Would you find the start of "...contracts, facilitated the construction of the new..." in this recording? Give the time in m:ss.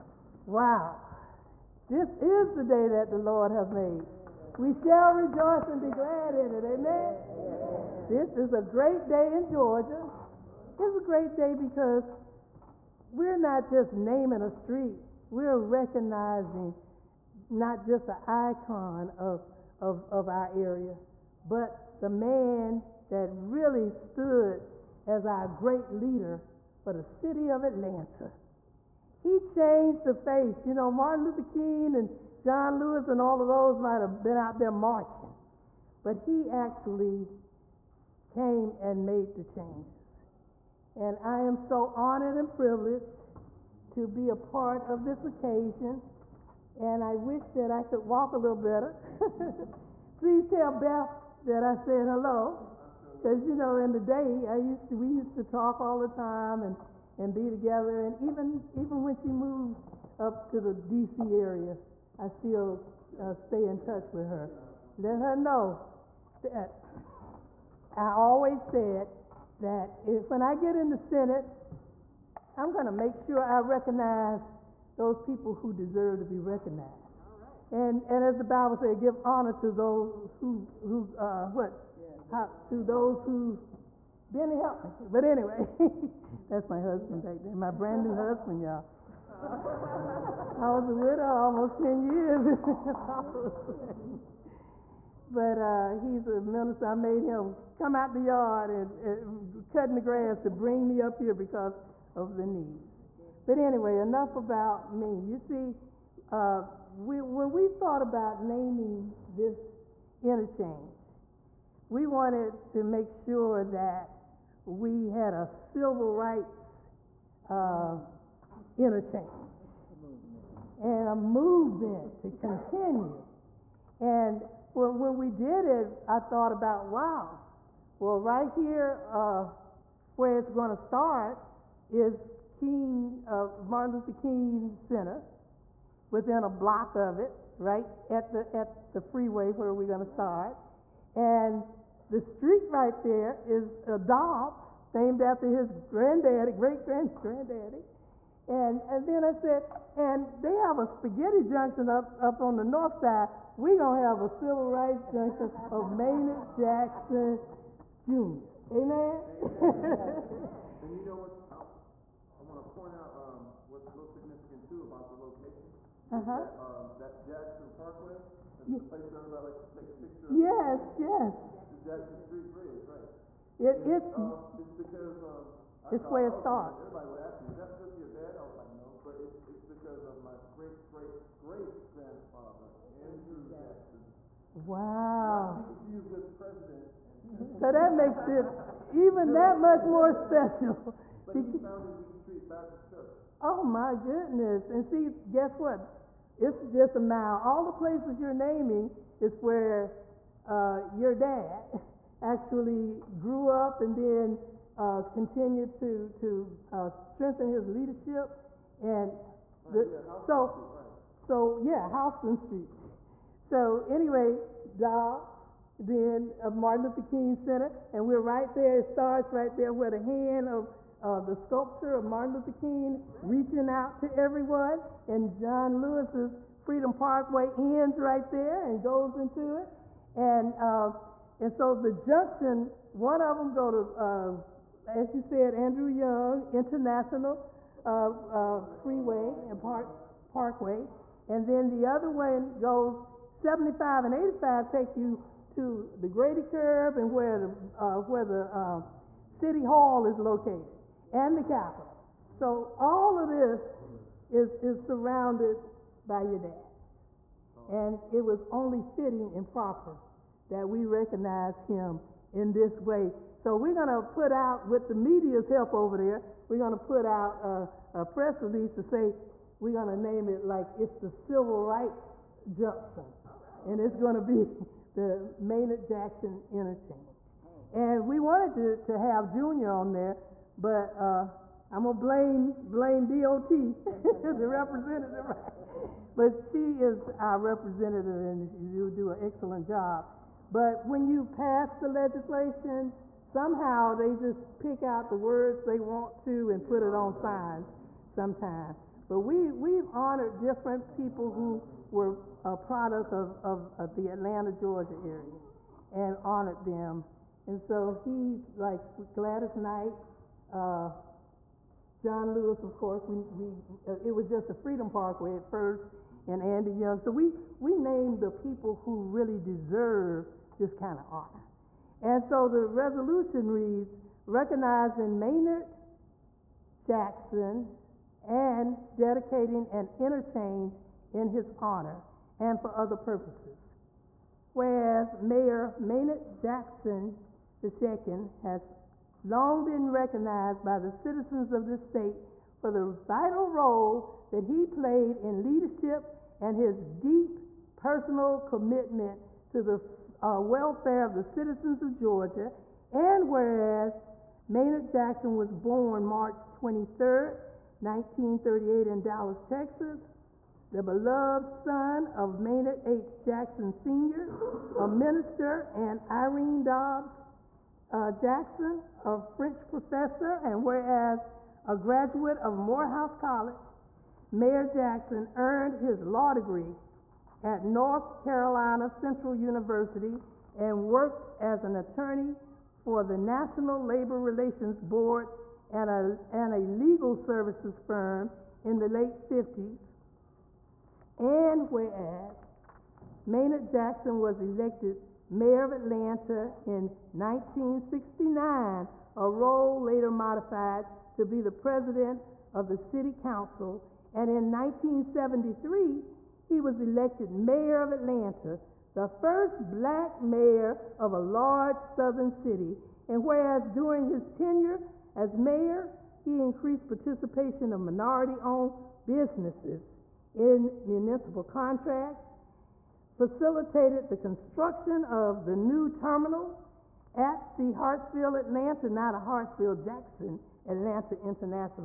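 7:01.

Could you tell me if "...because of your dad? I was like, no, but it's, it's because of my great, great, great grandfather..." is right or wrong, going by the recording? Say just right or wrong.
right.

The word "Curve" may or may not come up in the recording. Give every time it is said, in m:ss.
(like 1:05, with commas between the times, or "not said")
4:06.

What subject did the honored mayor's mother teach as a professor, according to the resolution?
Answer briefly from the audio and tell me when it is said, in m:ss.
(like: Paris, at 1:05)
French, at 6:09.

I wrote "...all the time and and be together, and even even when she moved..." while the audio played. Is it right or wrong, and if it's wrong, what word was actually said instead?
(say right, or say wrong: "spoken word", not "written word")
right.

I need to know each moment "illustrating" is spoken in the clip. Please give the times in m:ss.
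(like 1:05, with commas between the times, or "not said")
not said.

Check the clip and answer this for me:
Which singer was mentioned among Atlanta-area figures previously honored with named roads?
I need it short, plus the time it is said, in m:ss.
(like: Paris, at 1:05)
Gladys Knight, at 5:09.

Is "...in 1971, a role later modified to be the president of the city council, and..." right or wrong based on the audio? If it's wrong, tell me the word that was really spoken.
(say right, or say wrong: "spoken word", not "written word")
wrong: "1969", not "1971".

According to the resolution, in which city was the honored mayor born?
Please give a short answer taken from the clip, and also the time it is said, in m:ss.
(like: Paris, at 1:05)
Dallas, Texas, at 5:59.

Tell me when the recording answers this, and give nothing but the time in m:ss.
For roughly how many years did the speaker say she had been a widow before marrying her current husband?
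1:31.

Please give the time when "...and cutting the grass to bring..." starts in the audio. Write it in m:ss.
1:39.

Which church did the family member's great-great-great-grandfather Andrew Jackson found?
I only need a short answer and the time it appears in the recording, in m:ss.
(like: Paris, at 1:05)
Wheat Street Baptist Church, at 3:11.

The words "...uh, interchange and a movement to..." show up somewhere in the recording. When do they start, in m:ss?
1:57.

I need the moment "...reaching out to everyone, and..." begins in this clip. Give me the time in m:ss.
3:43.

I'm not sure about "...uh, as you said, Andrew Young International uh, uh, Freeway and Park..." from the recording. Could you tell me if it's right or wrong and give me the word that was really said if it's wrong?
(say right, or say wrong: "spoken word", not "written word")
right.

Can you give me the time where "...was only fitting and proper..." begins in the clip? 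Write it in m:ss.
4:18.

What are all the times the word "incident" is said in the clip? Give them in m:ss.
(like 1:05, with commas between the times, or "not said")
not said.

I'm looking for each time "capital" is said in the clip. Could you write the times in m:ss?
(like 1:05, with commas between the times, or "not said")
4:11.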